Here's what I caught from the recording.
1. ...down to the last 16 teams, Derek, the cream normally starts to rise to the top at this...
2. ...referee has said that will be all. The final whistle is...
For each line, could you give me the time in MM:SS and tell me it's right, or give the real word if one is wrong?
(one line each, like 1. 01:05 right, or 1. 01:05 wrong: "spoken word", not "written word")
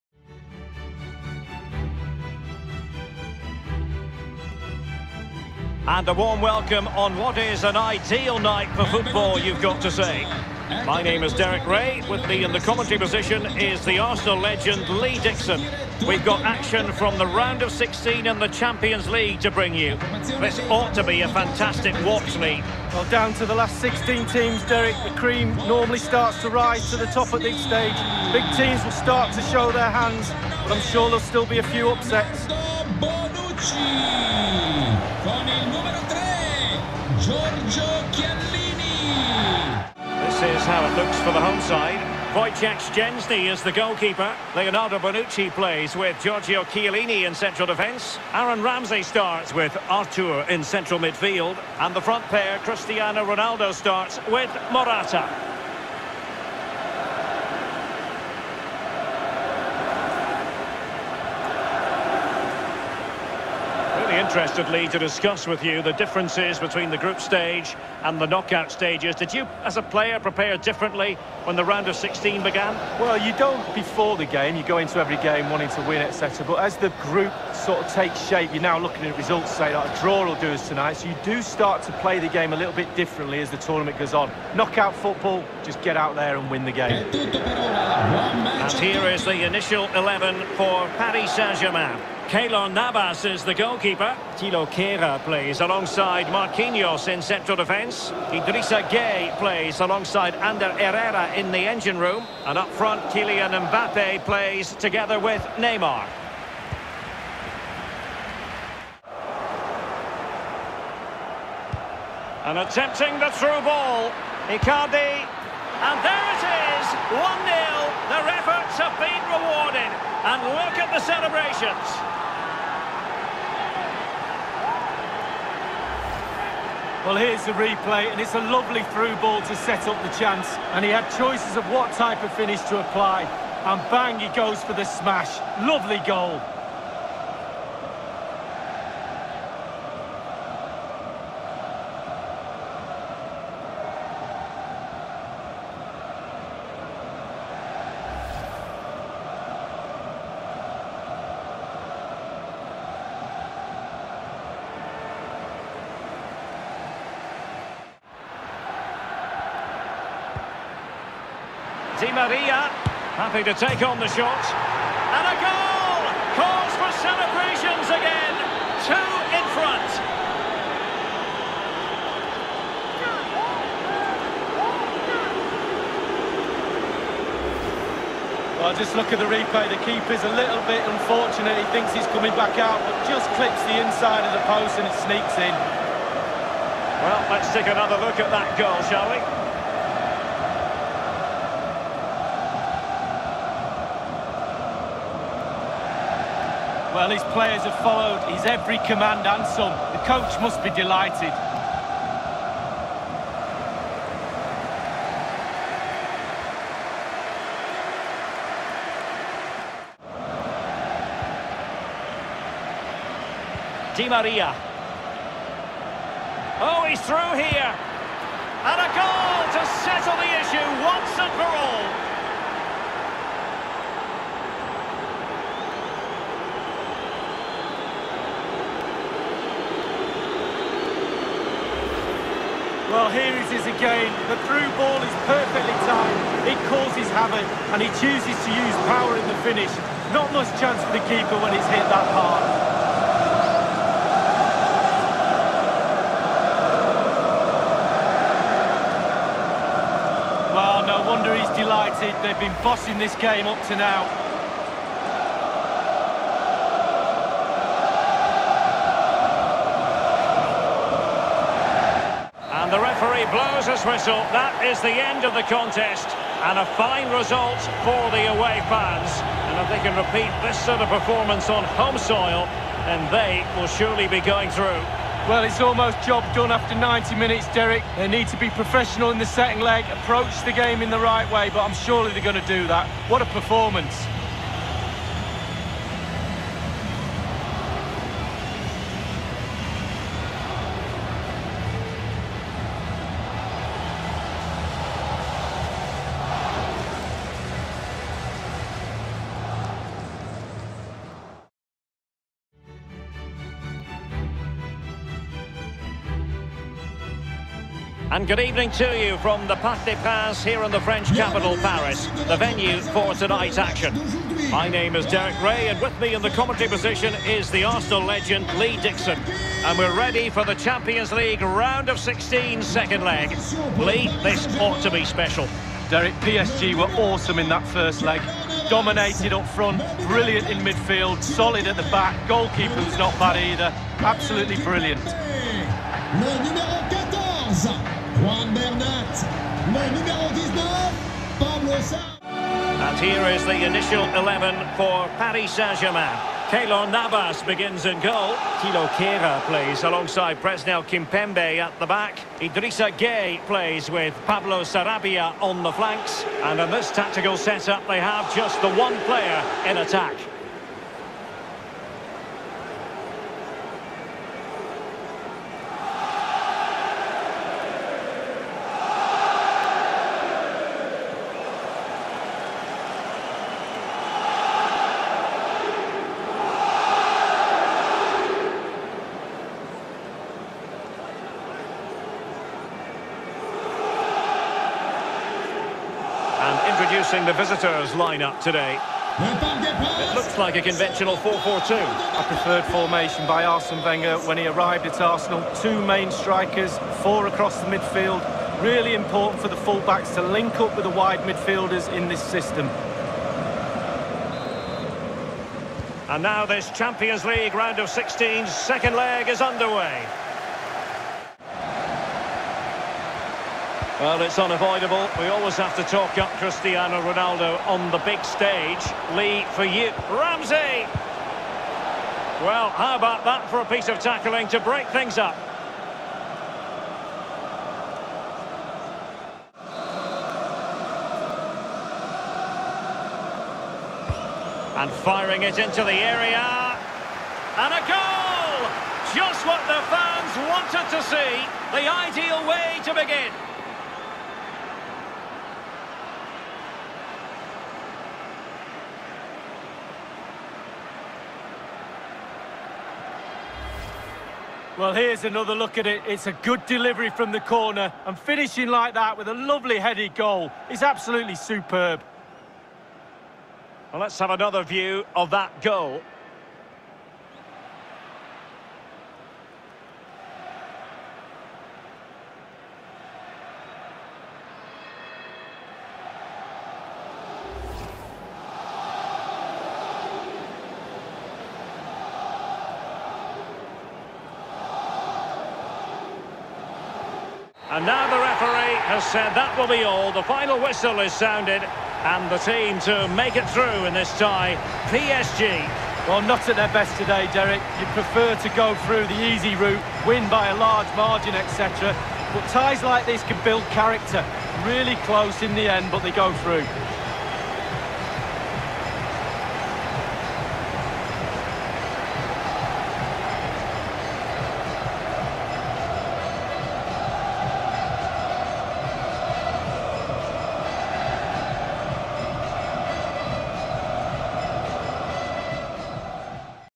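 1. 00:23 right
2. 08:08 right.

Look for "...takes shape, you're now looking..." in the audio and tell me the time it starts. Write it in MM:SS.
01:17.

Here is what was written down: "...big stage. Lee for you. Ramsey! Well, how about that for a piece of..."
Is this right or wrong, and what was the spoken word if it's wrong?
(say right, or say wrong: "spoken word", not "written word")
right.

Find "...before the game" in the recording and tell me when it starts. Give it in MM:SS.
01:13.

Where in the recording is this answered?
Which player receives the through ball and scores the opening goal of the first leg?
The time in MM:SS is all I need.
01:54.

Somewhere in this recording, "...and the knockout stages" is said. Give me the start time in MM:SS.
01:08.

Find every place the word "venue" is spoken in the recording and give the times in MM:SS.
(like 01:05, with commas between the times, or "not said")
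05:12.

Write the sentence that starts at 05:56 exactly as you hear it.
And in this tactical setup, they have just the one player in attack.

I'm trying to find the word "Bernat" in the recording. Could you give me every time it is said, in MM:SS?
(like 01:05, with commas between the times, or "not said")
05:38.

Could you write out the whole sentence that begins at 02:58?
Well, just look at the replay.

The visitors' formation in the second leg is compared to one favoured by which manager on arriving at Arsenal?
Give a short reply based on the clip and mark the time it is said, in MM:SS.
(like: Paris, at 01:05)
Arsene Wenger, at 06:33.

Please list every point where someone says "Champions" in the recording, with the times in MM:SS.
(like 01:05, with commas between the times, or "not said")
00:18, 05:20, 06:46.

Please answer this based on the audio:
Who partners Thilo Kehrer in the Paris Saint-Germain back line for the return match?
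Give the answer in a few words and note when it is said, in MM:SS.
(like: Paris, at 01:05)
Presnel Kimpembe, at 05:50.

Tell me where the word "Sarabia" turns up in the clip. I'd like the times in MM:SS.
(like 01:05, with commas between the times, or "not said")
05:54.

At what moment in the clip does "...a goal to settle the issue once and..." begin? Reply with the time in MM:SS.
03:38.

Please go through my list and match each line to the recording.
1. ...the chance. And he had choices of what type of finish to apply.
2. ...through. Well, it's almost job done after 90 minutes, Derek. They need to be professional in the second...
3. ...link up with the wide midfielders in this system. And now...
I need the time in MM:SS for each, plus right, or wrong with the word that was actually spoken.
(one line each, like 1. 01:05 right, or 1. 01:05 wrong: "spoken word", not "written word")
1. 02:10 right
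2. 04:34 right
3. 06:40 right.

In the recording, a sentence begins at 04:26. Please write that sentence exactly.
And a fine result for the away fans.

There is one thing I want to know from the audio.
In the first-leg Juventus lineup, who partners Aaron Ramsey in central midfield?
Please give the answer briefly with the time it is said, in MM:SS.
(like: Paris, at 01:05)
Arthur, at 00:49.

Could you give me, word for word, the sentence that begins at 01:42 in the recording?
And up front, Kylian Mbappe plays together with Neymar.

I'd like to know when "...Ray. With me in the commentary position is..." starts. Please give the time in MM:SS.
00:11.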